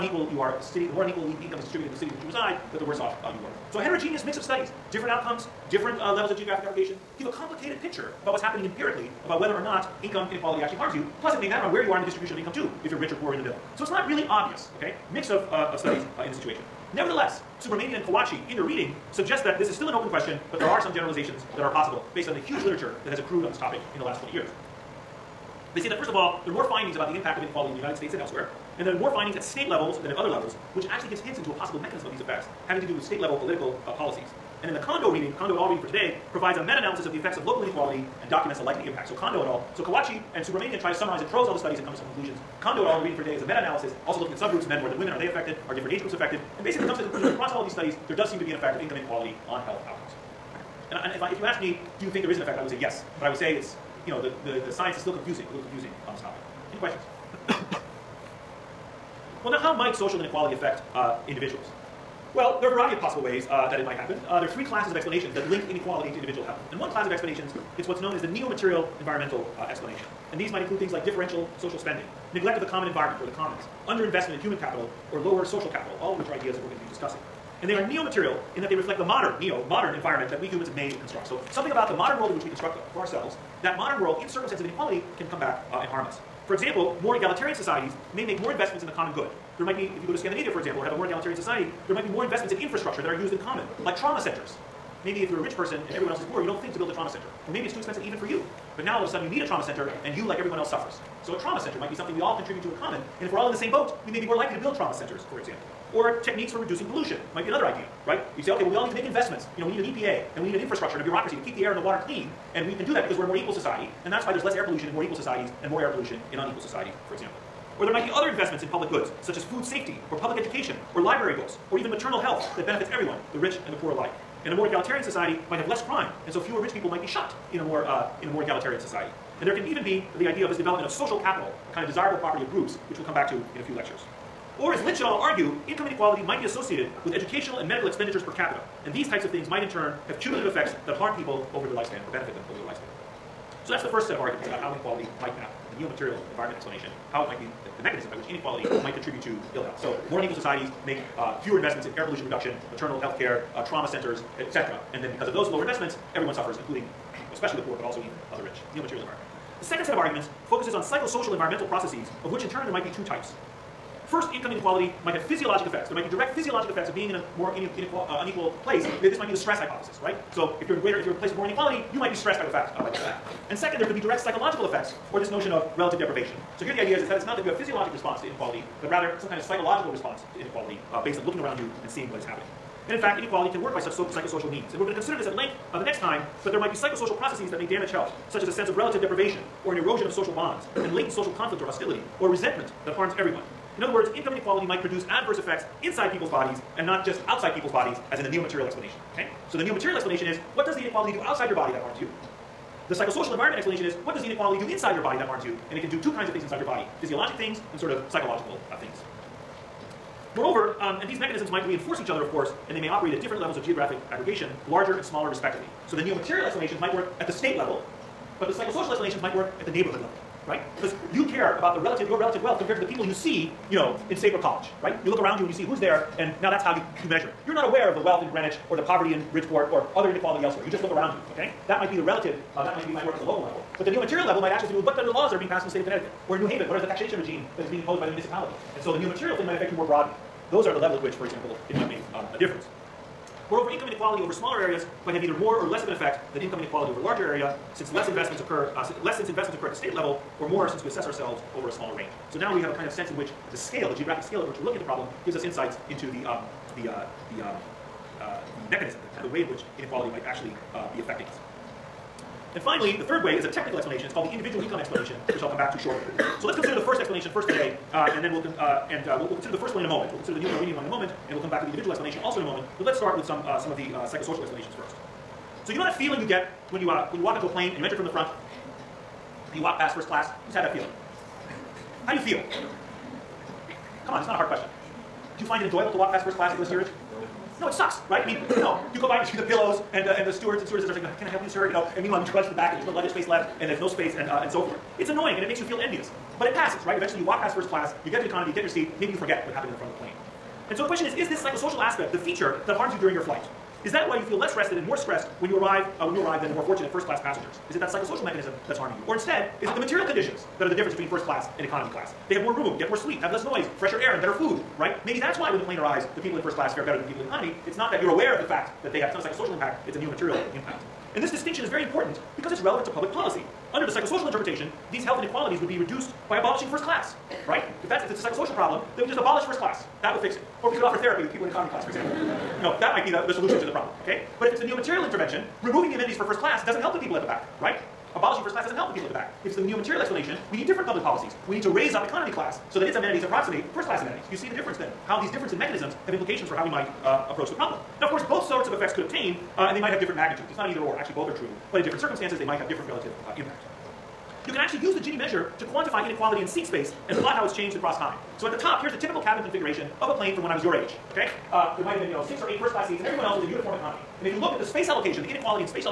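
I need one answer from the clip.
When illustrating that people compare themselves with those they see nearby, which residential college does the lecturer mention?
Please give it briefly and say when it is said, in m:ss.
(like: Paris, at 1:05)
Saybrook College, at 3:44.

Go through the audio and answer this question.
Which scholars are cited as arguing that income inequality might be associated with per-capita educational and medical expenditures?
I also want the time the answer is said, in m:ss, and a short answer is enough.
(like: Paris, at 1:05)
Lynch et al., at 2:14.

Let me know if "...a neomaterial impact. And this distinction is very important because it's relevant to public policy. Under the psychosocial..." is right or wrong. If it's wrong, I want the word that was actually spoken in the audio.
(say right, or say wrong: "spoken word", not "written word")
right.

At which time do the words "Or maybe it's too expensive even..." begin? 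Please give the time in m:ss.
1:37.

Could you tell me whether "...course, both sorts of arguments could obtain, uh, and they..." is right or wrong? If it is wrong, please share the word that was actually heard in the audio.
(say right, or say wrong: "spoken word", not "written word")
wrong: "effects", not "arguments".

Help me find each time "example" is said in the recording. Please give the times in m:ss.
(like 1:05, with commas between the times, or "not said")
1:26, 1:30, 1:45, 1:57, 4:01, 5:31.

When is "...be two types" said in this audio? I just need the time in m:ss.
2:42.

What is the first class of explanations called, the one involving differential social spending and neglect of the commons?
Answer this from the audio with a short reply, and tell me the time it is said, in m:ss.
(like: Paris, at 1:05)
neo-material environmental, at 1:08.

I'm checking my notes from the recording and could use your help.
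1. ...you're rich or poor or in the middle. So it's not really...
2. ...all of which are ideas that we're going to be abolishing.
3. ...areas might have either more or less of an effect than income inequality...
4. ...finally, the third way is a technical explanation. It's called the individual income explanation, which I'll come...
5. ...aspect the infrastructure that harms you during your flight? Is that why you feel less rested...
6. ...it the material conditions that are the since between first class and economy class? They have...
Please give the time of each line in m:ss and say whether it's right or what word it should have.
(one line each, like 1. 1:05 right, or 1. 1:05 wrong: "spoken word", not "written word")
1. 0:12 right
2. 1:16 wrong: "discussing", not "abolishing"
3. 4:04 right
4. 4:22 right
5. 5:01 wrong: "feature", not "infrastructure"
6. 5:09 wrong: "difference", not "since".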